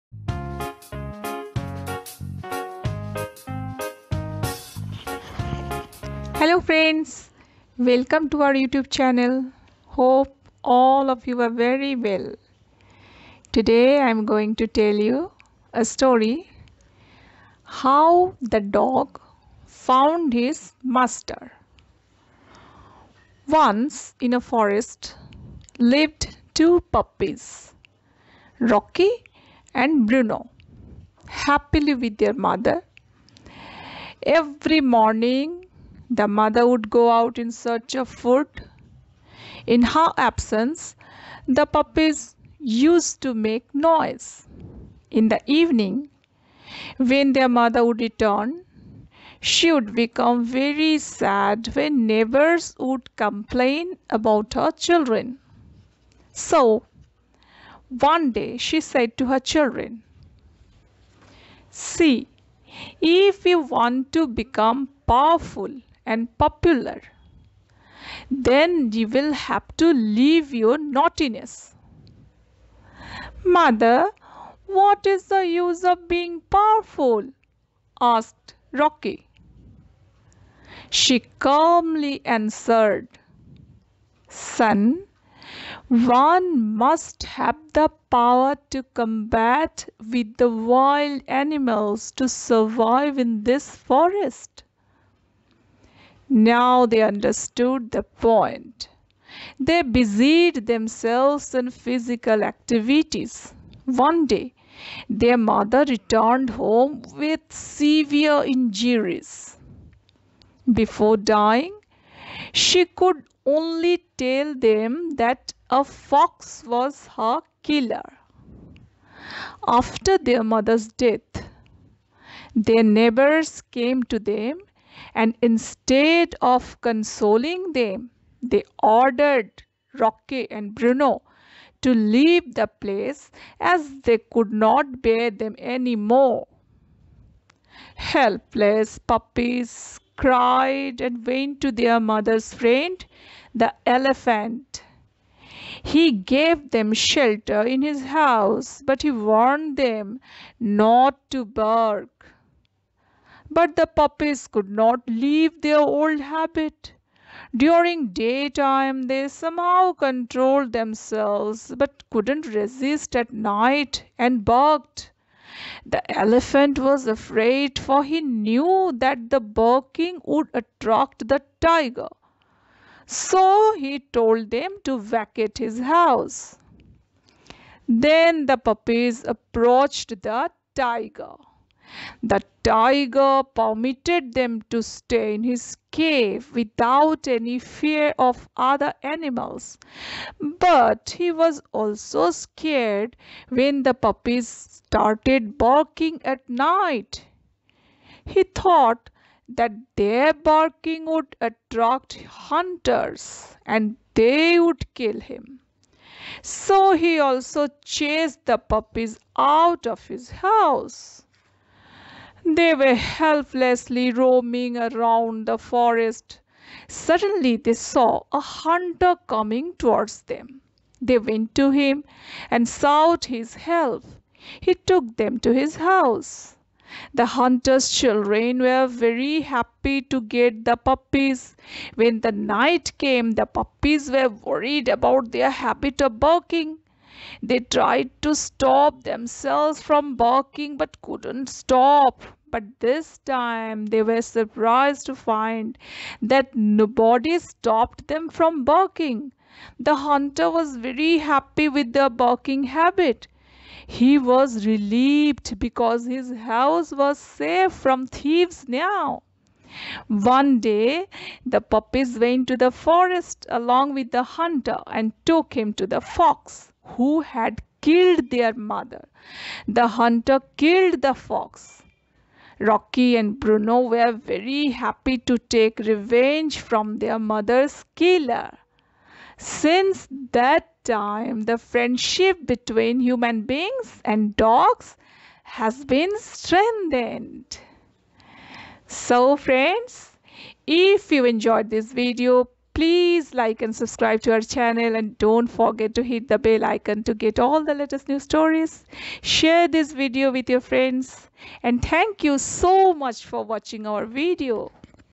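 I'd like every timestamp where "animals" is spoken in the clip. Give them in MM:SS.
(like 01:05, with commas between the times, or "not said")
01:31, 03:09.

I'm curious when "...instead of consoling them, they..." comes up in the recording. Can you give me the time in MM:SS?
02:05.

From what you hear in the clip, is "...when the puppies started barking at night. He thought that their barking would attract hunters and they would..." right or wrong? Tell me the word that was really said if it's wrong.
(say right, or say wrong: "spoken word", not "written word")
right.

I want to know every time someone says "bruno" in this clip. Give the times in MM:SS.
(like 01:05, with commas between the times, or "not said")
00:30, 02:10, 04:33.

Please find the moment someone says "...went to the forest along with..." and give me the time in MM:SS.
04:22.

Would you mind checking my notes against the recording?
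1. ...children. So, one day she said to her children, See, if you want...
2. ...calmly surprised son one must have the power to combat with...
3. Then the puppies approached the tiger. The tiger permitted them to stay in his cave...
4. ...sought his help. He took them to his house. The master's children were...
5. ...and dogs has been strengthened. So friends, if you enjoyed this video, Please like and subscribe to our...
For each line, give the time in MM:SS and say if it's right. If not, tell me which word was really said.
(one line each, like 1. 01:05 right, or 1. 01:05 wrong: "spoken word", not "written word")
1. 00:54 right
2. 01:21 wrong: "answered", not "surprised"
3. 02:57 right
4. 03:42 wrong: "hunter", not "master"
5. 04:44 right.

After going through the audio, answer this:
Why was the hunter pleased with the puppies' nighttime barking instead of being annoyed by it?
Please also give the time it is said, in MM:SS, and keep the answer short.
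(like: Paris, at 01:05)
Safe from thieves, at 04:17.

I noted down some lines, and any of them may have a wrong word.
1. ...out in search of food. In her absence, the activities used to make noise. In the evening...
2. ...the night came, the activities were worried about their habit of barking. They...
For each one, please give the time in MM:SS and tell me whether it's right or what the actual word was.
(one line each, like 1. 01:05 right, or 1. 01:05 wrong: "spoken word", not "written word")
1. 00:37 wrong: "puppies", not "activities"
2. 03:52 wrong: "puppies", not "activities".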